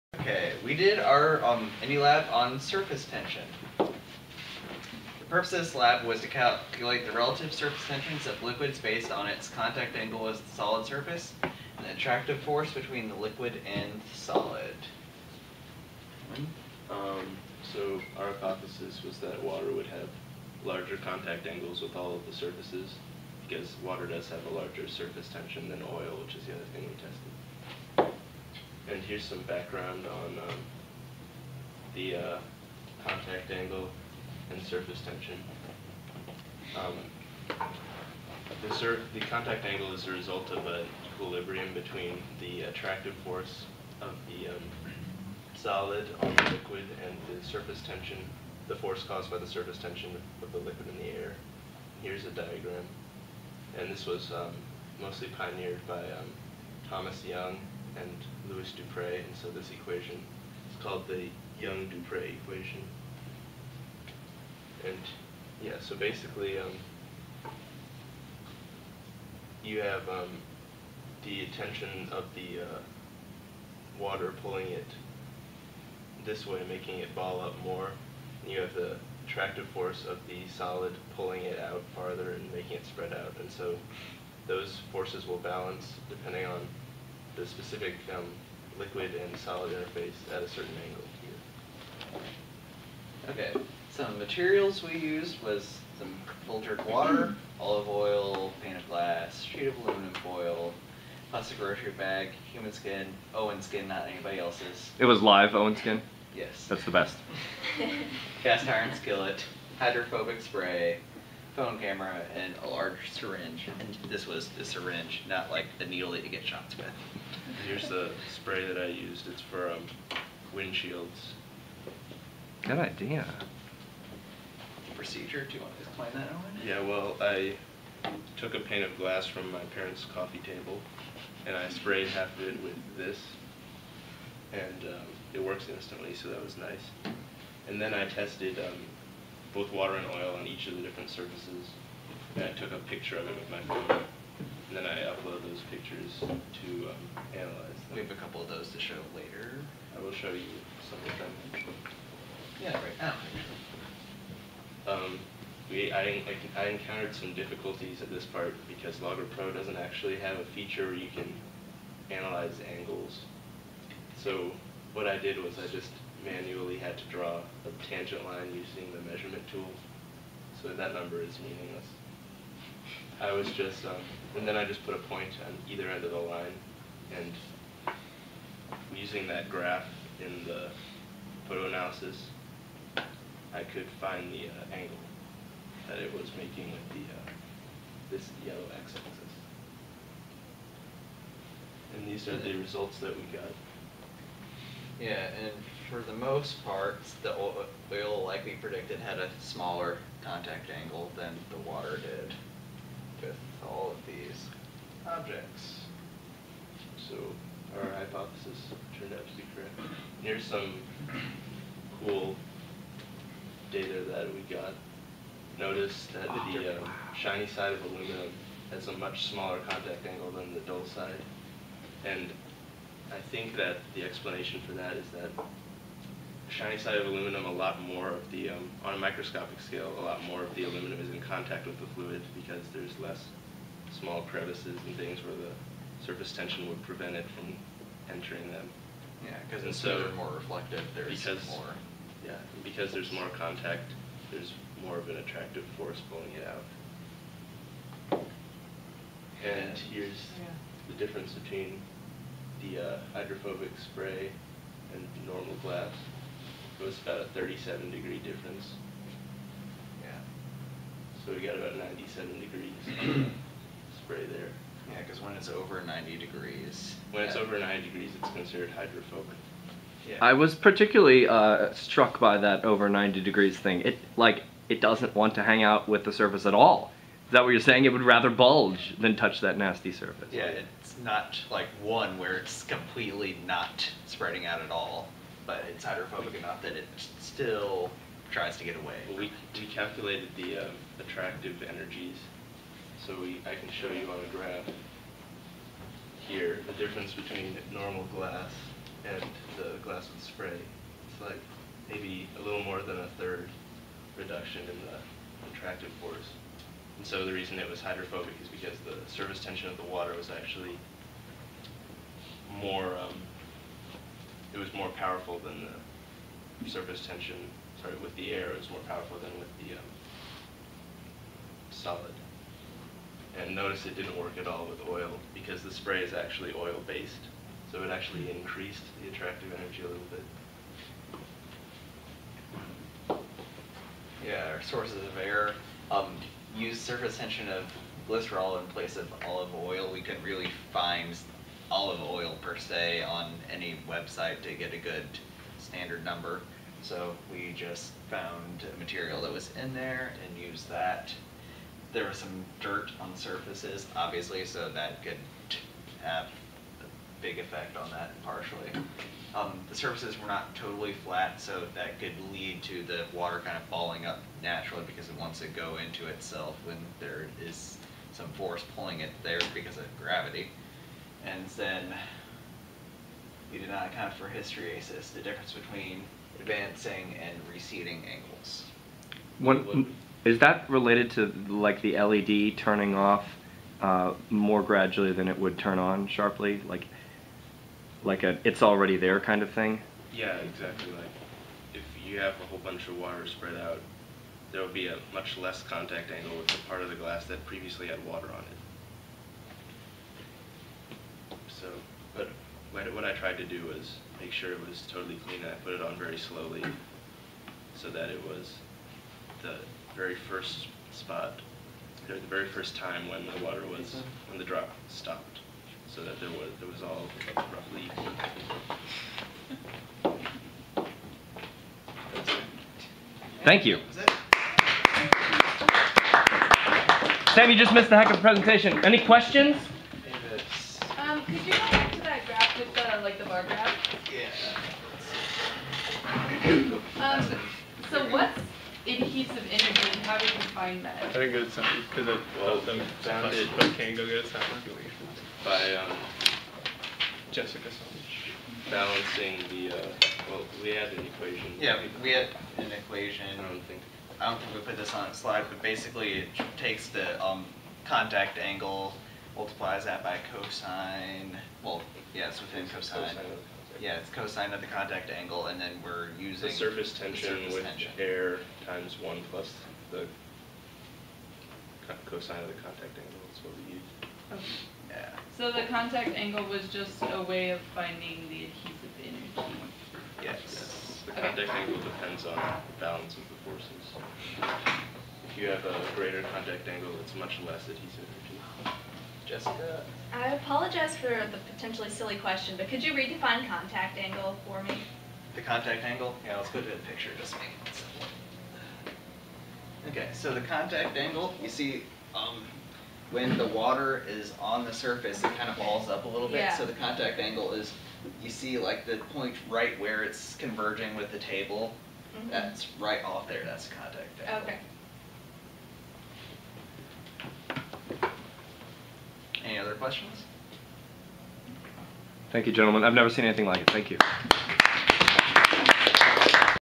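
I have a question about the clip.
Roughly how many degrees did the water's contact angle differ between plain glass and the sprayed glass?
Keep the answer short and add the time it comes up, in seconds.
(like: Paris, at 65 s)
37 degrees, at 257 s.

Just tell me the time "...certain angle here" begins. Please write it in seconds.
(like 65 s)
90 s.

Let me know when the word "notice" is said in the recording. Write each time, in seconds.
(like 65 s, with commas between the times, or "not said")
215 s, 323 s.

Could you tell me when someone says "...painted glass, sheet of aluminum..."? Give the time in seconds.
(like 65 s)
98 s.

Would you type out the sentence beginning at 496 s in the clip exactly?
Yeah, let's go to the picture, just make it simple.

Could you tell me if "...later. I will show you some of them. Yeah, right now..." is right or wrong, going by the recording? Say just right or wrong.
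right.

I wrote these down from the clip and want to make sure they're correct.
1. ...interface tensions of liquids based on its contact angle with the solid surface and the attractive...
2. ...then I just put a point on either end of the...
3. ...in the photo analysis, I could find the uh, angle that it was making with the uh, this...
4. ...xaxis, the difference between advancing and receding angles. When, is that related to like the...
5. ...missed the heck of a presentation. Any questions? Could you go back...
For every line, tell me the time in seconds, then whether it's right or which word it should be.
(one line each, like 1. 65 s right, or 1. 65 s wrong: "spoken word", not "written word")
1. 7 s wrong: "surface", not "interface"
2. 174 s right
3. 180 s right
4. 374 s wrong: "hysteresis", not "xaxis"
5. 427 s right.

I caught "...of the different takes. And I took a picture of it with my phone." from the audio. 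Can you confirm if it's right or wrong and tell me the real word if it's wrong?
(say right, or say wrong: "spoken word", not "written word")
wrong: "surfaces", not "takes".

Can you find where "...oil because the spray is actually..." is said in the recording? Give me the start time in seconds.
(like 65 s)
324 s.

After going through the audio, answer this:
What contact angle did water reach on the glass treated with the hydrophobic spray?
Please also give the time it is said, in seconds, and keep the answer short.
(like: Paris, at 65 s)
97 degrees, at 261 s.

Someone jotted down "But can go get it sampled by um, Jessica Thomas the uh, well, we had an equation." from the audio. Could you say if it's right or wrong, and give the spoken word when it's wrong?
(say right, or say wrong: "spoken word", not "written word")
wrong: "Balancing", not "Thomas".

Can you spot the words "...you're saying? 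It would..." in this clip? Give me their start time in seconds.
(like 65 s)
277 s.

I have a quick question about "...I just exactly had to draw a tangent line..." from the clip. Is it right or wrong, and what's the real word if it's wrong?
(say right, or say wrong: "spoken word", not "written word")
wrong: "manually", not "exactly".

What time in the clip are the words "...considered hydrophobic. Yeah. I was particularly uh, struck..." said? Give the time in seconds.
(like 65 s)
268 s.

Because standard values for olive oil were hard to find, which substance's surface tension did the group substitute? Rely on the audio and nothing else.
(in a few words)
Glycerol.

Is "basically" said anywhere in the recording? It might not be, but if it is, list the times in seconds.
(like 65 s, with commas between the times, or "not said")
65 s, 455 s.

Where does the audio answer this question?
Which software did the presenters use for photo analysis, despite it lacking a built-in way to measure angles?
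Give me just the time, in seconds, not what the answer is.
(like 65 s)
159 s.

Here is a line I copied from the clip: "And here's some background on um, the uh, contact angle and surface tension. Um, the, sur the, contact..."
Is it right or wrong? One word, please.
right.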